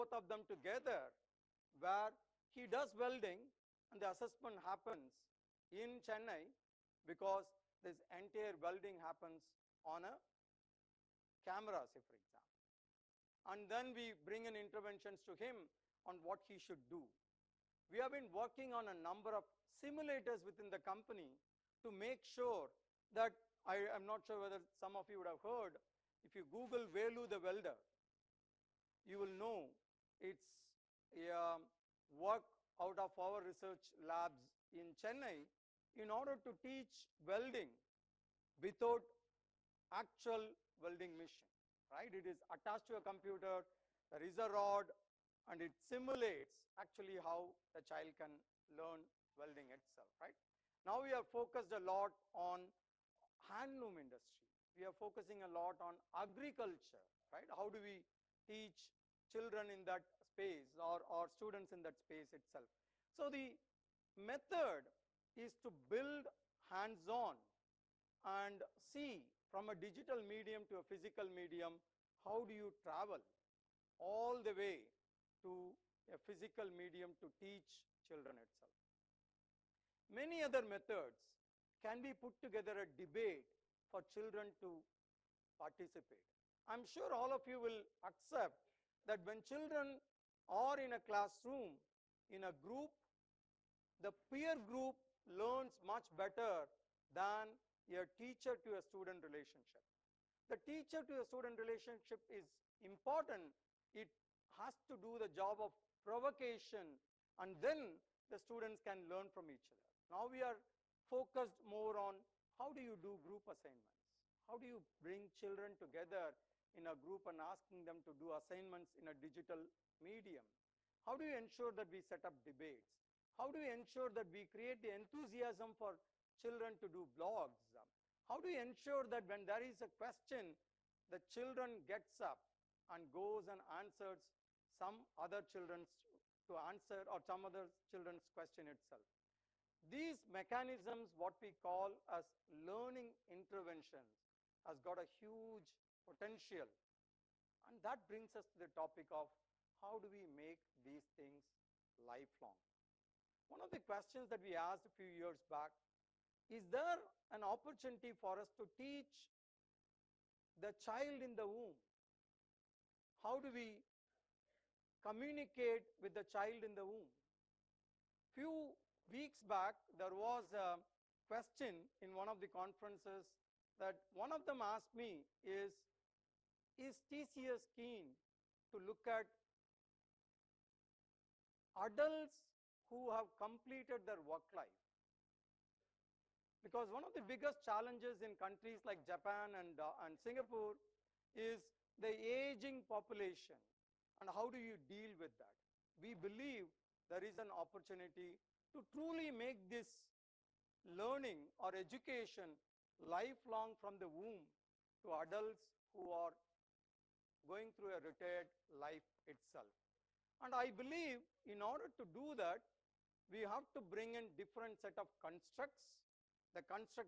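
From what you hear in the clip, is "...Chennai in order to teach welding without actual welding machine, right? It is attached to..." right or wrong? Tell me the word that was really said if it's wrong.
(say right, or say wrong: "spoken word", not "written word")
right.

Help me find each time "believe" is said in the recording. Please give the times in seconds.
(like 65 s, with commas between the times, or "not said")
196 s, 210 s.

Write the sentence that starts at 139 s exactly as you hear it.
These mechanisms, what we call as learning interventions, has got a huge potential.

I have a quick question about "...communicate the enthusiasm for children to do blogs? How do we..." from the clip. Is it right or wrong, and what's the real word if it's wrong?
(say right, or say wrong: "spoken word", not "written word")
wrong: "create", not "communicate".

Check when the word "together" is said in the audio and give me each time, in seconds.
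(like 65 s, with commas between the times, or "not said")
0 s, 82 s, 115 s.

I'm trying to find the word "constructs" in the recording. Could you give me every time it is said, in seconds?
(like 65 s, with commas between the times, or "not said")
215 s.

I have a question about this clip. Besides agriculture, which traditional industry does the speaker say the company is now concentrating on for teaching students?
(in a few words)
Handloom industry.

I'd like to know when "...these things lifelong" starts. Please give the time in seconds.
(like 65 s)
150 s.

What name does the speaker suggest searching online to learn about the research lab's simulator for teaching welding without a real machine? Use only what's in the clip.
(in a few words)
Velu the welder.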